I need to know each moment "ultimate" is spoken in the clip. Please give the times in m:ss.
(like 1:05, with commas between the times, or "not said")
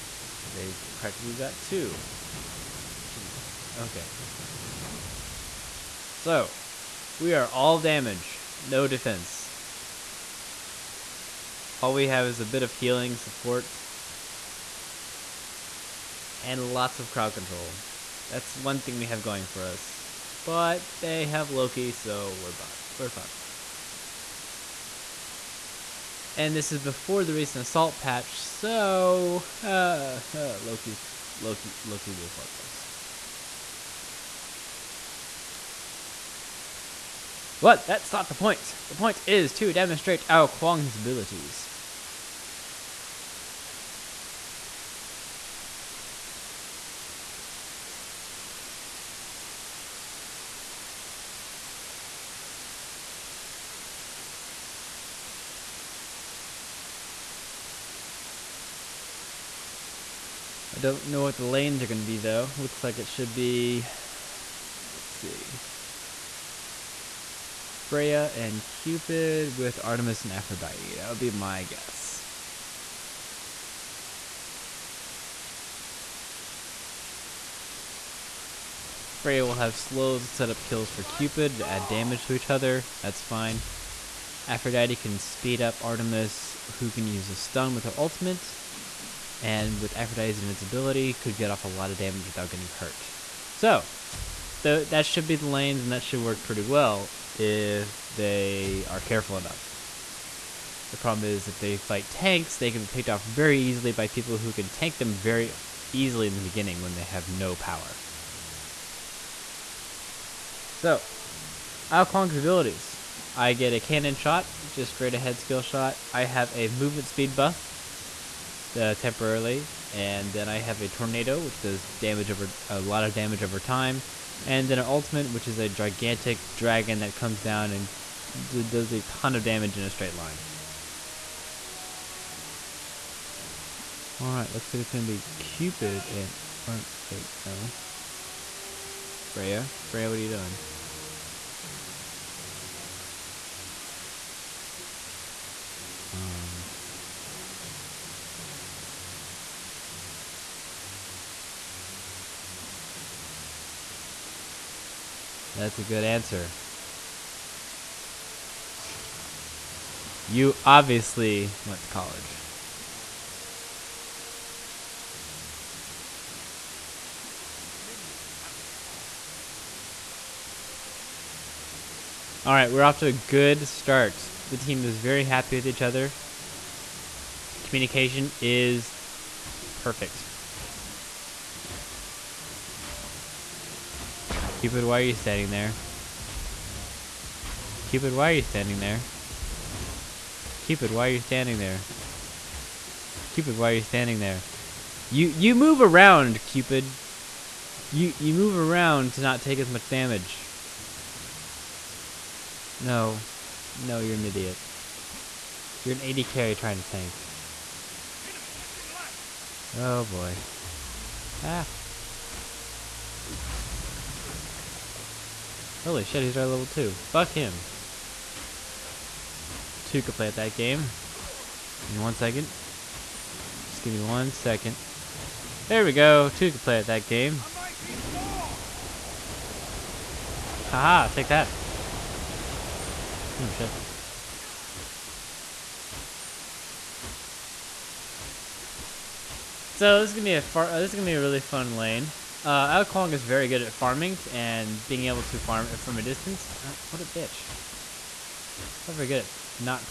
1:27, 2:04.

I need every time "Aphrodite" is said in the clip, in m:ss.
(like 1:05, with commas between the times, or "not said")
1:10, 1:24, 1:29.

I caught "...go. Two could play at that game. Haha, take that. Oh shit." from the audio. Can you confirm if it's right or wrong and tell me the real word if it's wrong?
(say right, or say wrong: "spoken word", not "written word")
right.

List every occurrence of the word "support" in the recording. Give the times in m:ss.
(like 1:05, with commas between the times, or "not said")
0:13.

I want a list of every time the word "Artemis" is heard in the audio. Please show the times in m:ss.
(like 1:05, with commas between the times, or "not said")
1:09, 1:25.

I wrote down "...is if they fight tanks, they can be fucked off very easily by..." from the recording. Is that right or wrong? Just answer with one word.
wrong.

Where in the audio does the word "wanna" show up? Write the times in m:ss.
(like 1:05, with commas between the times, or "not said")
not said.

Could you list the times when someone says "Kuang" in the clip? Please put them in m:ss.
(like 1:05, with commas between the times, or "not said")
0:40, 1:52, 4:02.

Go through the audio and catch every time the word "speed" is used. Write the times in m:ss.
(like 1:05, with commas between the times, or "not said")
1:25, 1:57.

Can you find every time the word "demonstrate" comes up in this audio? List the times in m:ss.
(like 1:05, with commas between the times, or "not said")
0:39.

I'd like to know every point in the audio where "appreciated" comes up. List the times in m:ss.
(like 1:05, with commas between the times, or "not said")
not said.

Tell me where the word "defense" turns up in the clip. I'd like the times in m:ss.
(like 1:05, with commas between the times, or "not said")
0:08.